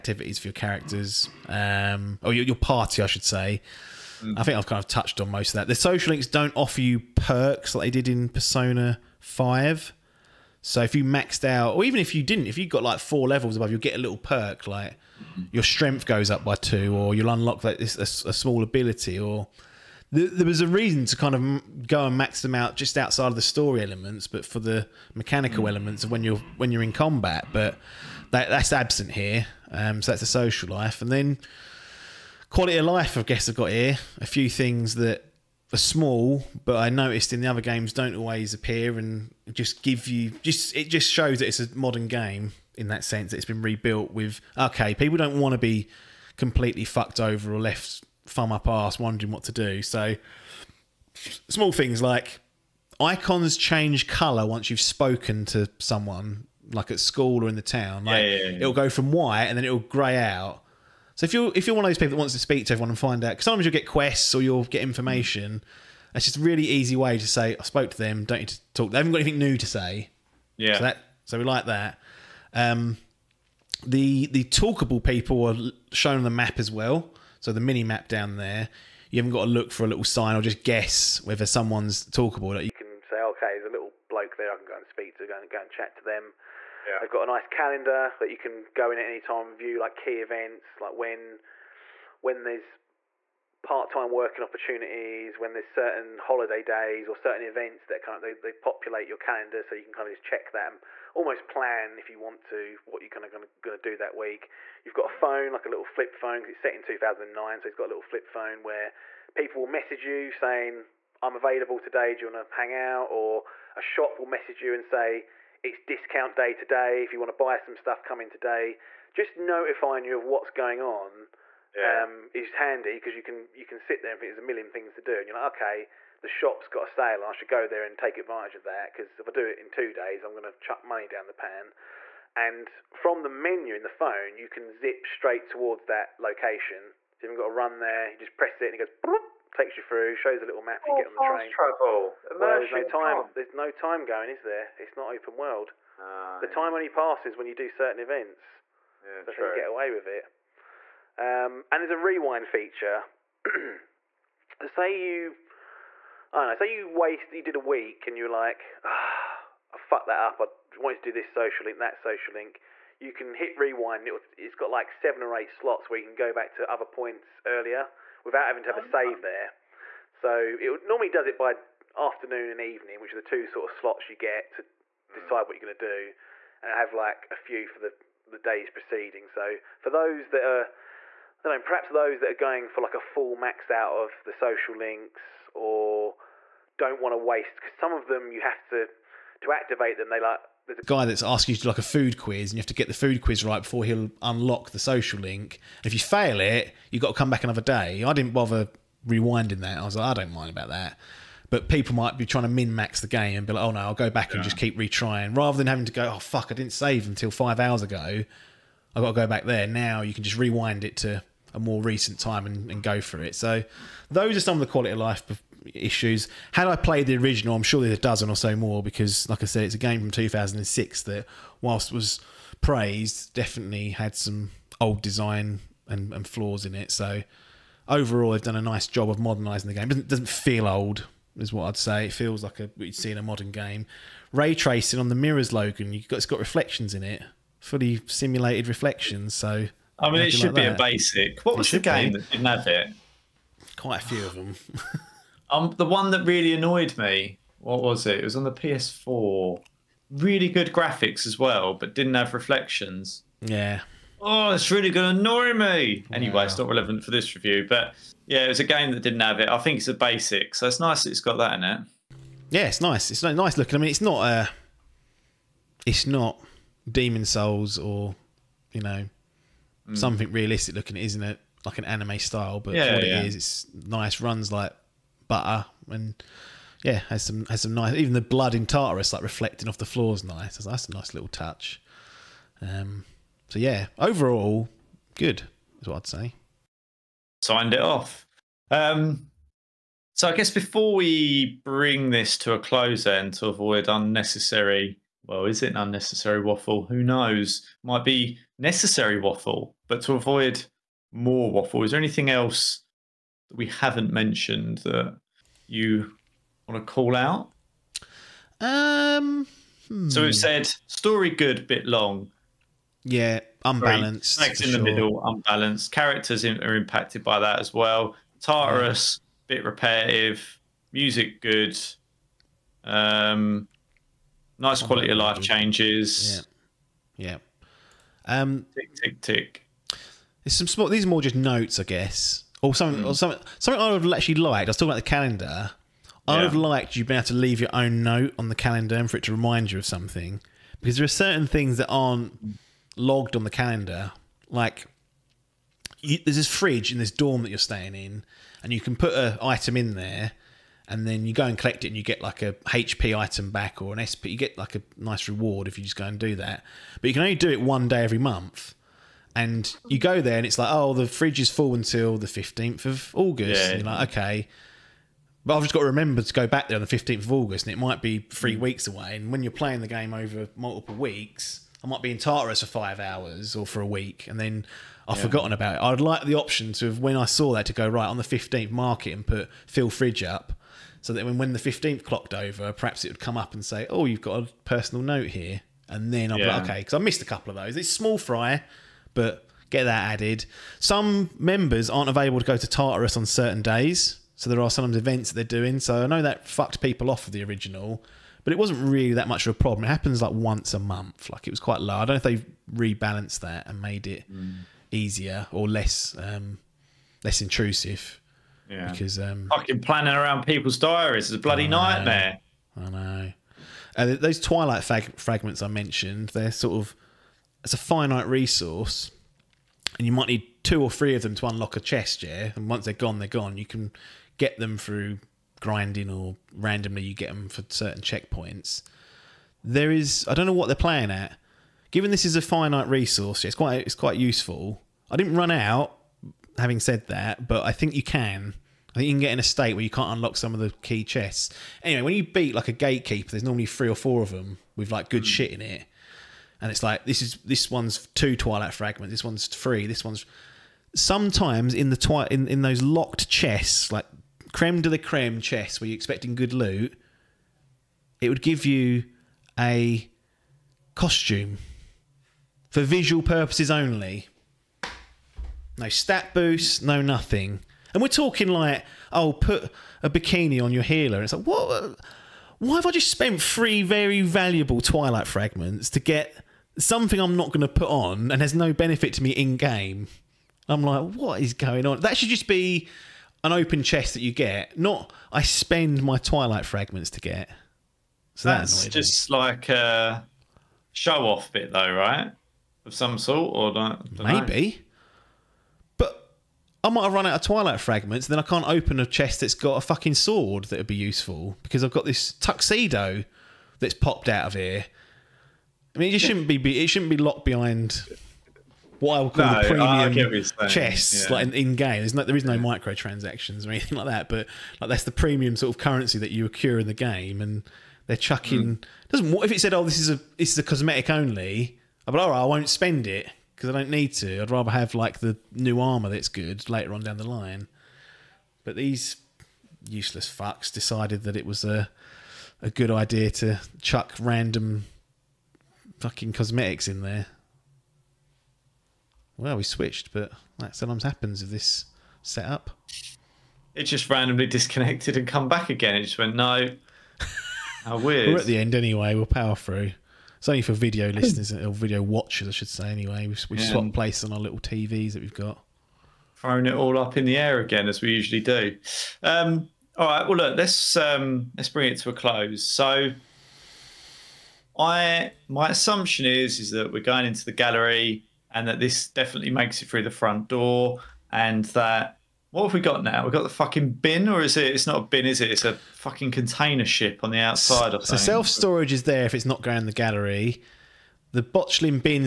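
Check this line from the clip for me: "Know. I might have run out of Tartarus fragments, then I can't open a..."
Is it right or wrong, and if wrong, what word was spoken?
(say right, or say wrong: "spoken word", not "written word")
wrong: "Twilight", not "Tartarus".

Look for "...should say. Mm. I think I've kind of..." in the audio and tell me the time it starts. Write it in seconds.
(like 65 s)
3 s.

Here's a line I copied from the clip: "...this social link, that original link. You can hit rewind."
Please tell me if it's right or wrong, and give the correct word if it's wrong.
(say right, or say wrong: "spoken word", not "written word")
wrong: "social", not "original".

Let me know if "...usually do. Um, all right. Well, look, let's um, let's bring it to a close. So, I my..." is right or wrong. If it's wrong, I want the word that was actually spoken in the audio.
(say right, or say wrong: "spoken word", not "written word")
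right.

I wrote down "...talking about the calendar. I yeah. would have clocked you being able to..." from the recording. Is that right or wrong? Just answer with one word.
wrong.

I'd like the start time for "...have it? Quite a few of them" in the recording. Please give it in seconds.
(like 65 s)
242 s.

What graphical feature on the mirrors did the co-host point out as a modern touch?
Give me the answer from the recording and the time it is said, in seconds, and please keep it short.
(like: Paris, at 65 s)
Ray tracing, at 234 s.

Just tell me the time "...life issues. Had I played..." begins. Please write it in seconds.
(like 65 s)
214 s.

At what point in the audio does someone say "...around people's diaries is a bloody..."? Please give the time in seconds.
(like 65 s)
410 s.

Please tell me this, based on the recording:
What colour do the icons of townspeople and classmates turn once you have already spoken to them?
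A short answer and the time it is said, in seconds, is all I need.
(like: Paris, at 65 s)
gray, at 59 s.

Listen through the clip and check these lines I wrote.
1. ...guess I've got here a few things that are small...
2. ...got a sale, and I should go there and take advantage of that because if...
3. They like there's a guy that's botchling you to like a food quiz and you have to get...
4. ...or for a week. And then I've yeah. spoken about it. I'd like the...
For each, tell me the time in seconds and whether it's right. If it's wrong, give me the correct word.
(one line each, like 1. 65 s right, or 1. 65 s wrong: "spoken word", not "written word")
1. 33 s right
2. 126 s right
3. 190 s wrong: "asking", not "botchling"
4. 373 s wrong: "forgotten", not "spoken".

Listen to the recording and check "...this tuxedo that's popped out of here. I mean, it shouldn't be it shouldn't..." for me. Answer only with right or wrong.
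right.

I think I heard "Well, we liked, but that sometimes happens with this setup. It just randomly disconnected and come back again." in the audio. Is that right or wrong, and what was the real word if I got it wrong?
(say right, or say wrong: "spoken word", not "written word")
wrong: "switched", not "liked".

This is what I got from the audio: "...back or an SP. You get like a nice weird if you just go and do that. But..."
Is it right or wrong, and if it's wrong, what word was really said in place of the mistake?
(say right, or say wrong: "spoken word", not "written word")
wrong: "reward", not "weird".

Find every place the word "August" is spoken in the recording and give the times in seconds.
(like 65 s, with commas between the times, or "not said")
363 s, 367 s.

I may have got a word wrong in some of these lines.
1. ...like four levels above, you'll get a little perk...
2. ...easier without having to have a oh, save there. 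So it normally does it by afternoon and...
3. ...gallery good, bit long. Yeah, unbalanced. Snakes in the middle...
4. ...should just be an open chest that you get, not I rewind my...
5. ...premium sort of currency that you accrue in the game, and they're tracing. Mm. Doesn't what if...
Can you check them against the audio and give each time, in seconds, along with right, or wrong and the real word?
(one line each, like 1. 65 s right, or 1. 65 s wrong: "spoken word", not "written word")
1. 12 s right
2. 167 s wrong: "earlier", not "easier"
3. 310 s wrong: "story", not "gallery"
4. 482 s wrong: "spend", not "rewind"
5. 515 s wrong: "chucking", not "tracing".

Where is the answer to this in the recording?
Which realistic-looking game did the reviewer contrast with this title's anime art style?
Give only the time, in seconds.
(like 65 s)
266 s.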